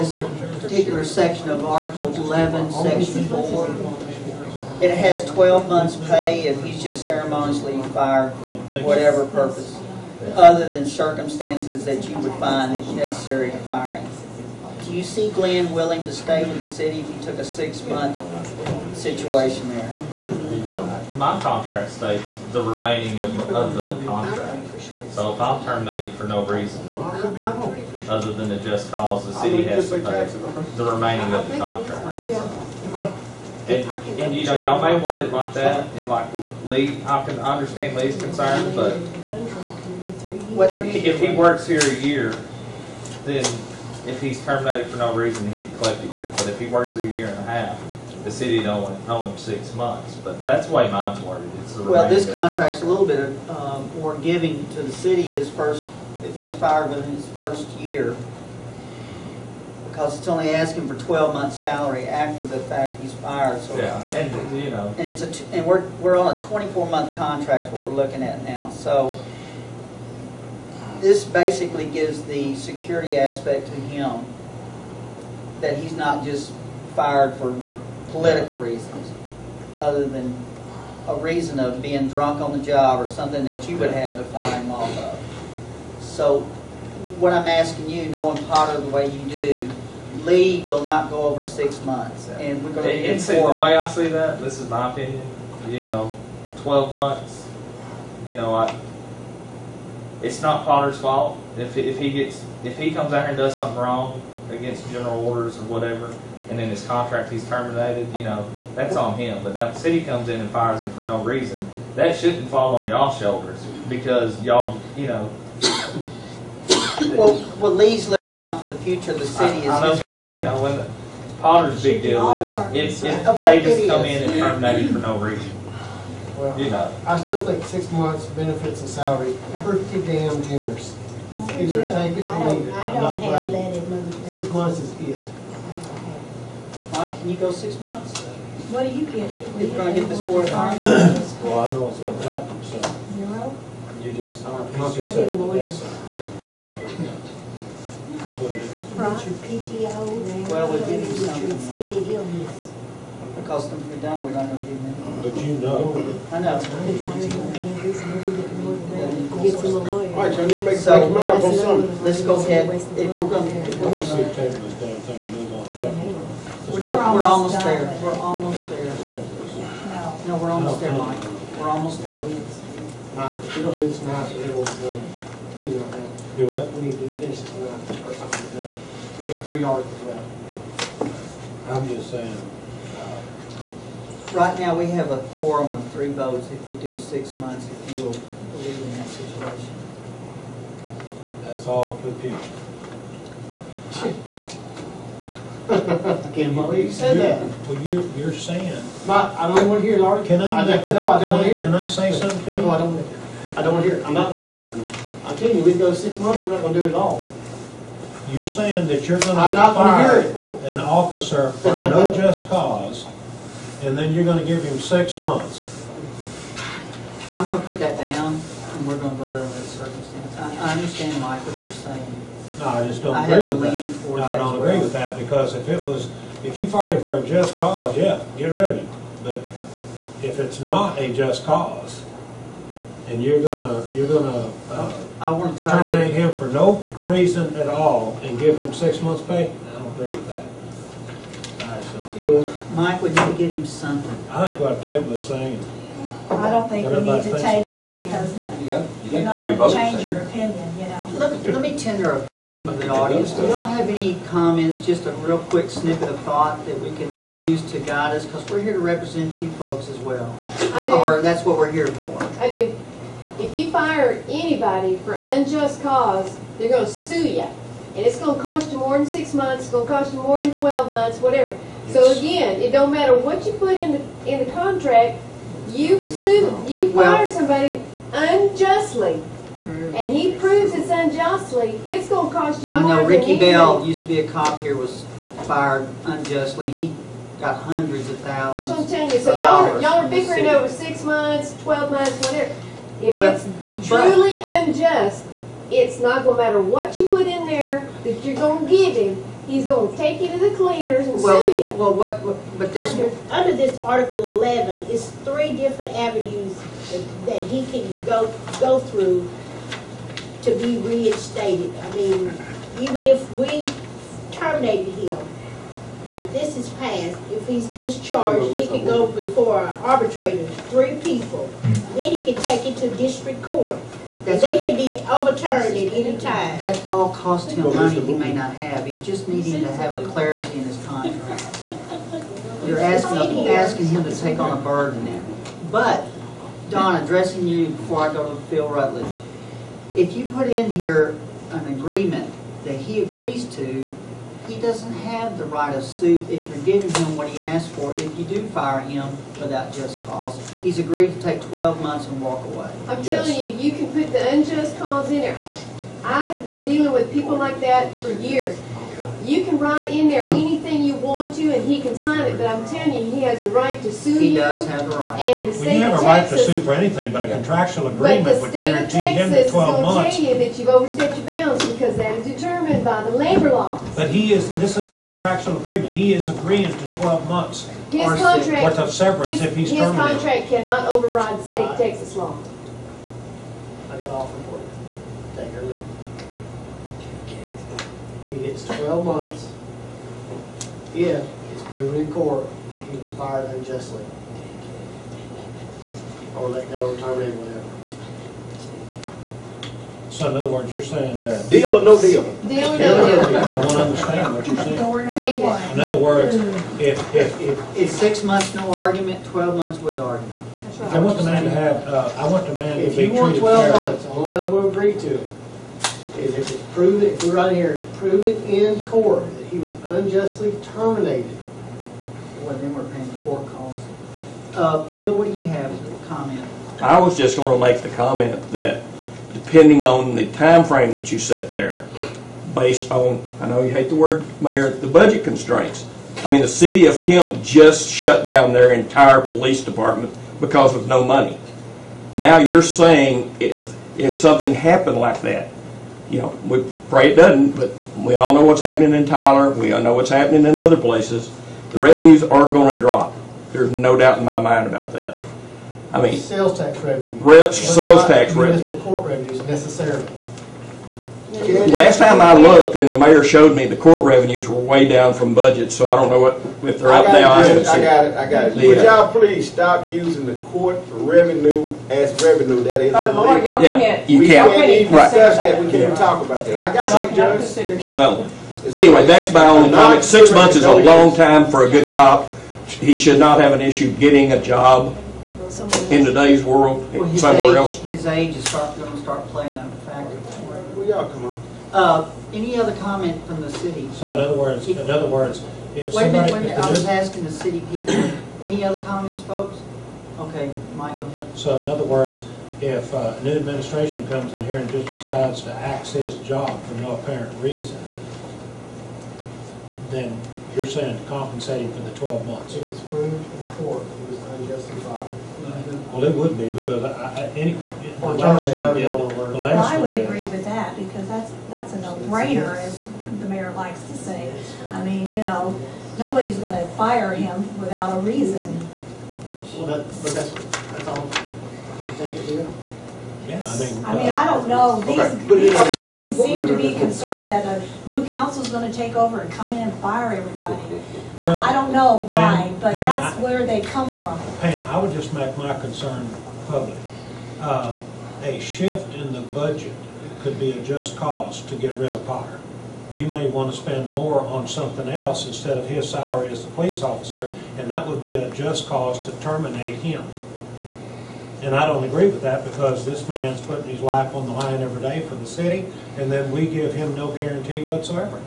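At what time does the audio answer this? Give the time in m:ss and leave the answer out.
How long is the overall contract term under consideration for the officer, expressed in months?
1:06.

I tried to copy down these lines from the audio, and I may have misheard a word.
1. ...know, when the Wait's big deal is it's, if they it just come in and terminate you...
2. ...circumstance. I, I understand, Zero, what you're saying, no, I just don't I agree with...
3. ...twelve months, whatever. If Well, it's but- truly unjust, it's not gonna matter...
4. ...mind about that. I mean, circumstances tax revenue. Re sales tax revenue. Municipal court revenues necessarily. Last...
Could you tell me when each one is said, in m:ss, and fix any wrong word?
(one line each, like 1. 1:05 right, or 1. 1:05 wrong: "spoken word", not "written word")
1. 2:00 wrong: "Potter", not "Wait"
2. 3:39 wrong: "Mike", not "Zero"
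3. 4:51 right
4. 7:34 wrong: "sales", not "circumstances".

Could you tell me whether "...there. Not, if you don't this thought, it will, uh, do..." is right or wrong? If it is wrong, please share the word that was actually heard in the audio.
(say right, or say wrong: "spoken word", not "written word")
wrong: "tonight", not "thought".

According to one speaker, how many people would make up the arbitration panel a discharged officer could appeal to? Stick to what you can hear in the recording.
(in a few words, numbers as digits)
3.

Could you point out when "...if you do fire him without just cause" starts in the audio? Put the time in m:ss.
5:47.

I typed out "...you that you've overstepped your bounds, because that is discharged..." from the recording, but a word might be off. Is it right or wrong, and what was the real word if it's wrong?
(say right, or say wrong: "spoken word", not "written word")
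wrong: "determined", not "discharged".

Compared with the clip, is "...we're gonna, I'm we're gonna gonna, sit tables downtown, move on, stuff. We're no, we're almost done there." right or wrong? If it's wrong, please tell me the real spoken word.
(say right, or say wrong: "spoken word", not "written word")
right.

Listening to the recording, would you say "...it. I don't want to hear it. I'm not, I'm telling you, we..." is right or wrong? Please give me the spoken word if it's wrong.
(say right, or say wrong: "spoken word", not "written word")
right.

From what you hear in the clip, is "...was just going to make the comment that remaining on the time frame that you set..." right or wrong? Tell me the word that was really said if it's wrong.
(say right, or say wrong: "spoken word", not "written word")
wrong: "depending", not "remaining".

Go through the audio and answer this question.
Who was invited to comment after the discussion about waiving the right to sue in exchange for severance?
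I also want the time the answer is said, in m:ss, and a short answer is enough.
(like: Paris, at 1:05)
Phil Rutledge, at 5:38.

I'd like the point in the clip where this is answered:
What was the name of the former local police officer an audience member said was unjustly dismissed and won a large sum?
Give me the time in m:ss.
4:43.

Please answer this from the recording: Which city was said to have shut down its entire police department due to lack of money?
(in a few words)
Kemp.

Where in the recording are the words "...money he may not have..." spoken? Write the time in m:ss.
5:27.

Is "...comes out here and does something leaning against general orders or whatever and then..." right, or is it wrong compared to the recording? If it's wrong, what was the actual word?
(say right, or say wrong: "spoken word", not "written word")
wrong: "wrong", not "leaning".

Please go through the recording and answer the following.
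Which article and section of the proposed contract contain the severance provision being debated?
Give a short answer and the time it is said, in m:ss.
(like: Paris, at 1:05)
Article 11, Section 4, at 0:01.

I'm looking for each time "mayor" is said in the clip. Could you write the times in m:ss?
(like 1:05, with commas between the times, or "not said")
7:14, 7:42, 8:43.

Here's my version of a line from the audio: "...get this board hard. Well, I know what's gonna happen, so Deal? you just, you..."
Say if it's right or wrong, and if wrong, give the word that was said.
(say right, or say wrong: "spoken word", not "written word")
wrong: "Zero", not "Deal".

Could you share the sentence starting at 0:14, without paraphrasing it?
Do you see Glenn willing to stay with the city if he took a six-month situation there?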